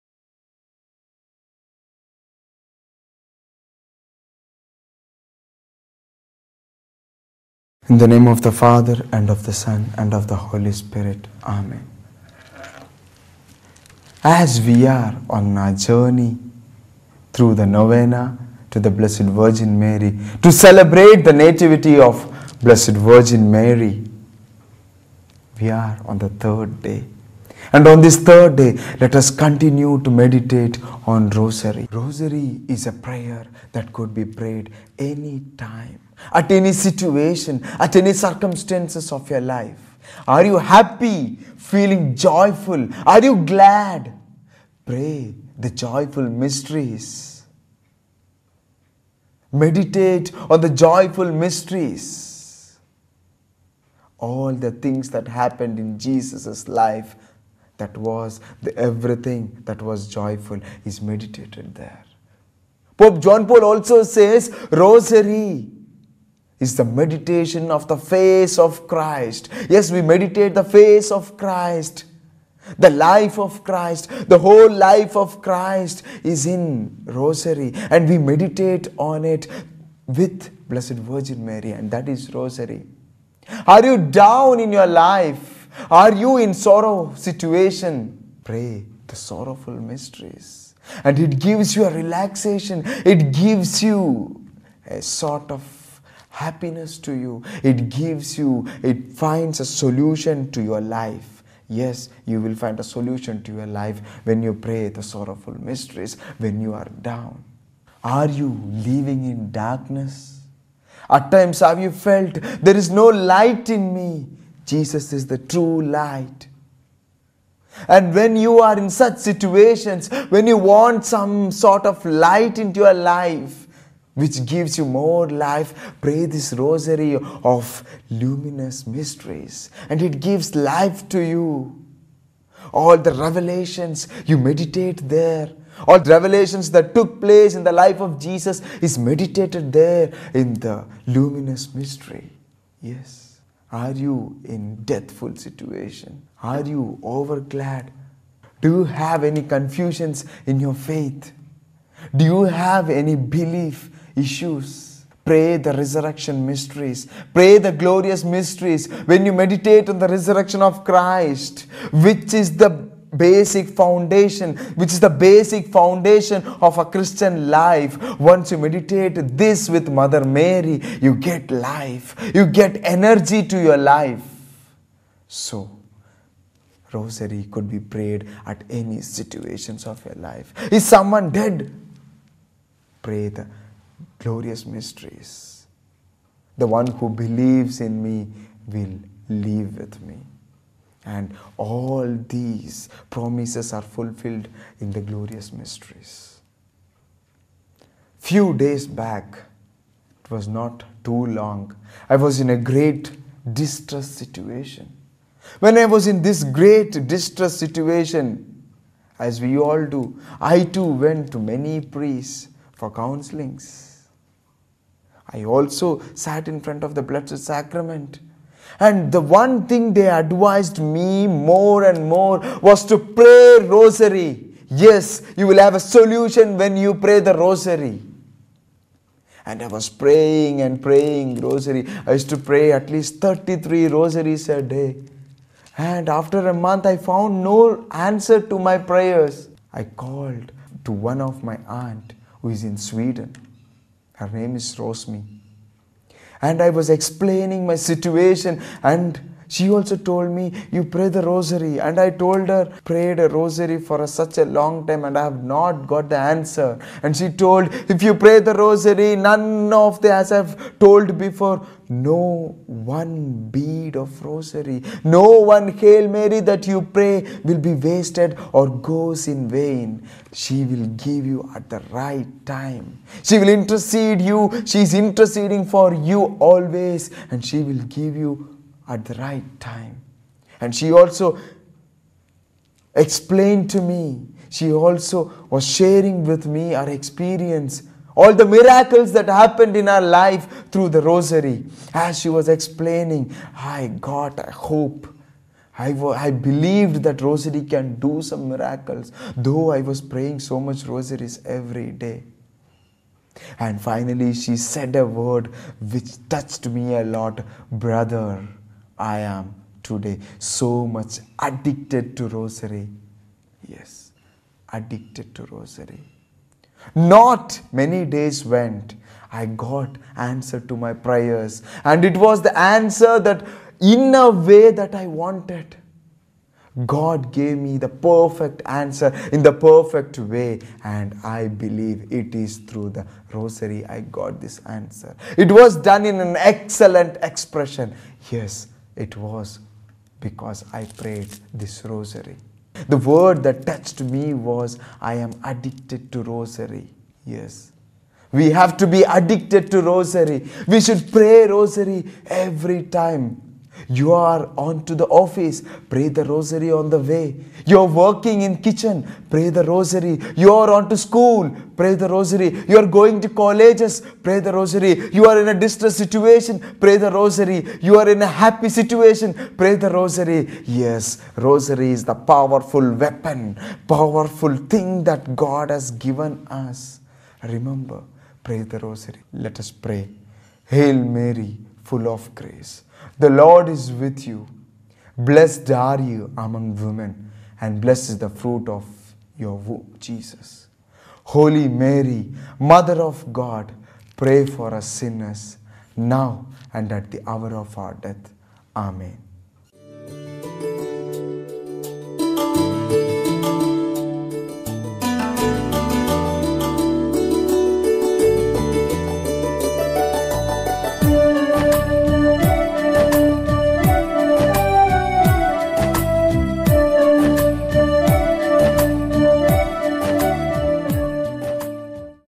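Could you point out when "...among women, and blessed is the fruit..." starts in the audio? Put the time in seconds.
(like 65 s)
386 s.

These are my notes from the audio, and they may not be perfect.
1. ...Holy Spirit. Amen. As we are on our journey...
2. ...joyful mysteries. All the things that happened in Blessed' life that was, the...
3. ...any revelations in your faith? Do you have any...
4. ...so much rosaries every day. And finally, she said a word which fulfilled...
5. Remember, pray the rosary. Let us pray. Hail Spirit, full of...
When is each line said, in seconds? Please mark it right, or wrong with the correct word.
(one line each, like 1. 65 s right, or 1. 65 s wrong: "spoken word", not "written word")
1. 10 s right
2. 50 s wrong: "Jesus", not "Blessed"
3. 149 s wrong: "confusions", not "revelations"
4. 300 s wrong: "touched", not "fulfilled"
5. 377 s wrong: "Mary", not "Spirit".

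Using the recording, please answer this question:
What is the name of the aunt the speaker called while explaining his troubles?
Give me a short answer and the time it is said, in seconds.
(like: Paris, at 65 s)
Rosmi, at 244 s.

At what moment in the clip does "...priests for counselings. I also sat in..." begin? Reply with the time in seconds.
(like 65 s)
211 s.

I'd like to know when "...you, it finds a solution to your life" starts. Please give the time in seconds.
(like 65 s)
98 s.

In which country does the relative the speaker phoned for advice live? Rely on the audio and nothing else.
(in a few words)
Sweden.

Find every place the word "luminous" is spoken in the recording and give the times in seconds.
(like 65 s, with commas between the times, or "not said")
128 s, 141 s.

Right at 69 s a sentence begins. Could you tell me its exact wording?
Yes, we meditate the face of Christ.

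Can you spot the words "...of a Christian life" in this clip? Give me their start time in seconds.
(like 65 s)
166 s.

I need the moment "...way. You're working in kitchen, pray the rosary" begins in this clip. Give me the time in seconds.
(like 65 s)
356 s.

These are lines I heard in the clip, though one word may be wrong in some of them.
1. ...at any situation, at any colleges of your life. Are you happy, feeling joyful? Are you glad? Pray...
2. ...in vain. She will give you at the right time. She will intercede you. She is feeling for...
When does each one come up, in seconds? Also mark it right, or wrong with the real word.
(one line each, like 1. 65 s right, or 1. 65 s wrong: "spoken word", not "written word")
1. 36 s wrong: "circumstances", not "colleges"
2. 269 s wrong: "interceding", not "feeling".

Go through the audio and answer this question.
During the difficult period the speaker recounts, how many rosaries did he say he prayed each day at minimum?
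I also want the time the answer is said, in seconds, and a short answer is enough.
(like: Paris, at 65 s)
33, at 233 s.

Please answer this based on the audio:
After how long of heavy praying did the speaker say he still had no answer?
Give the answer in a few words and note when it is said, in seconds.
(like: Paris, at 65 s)
a month, at 236 s.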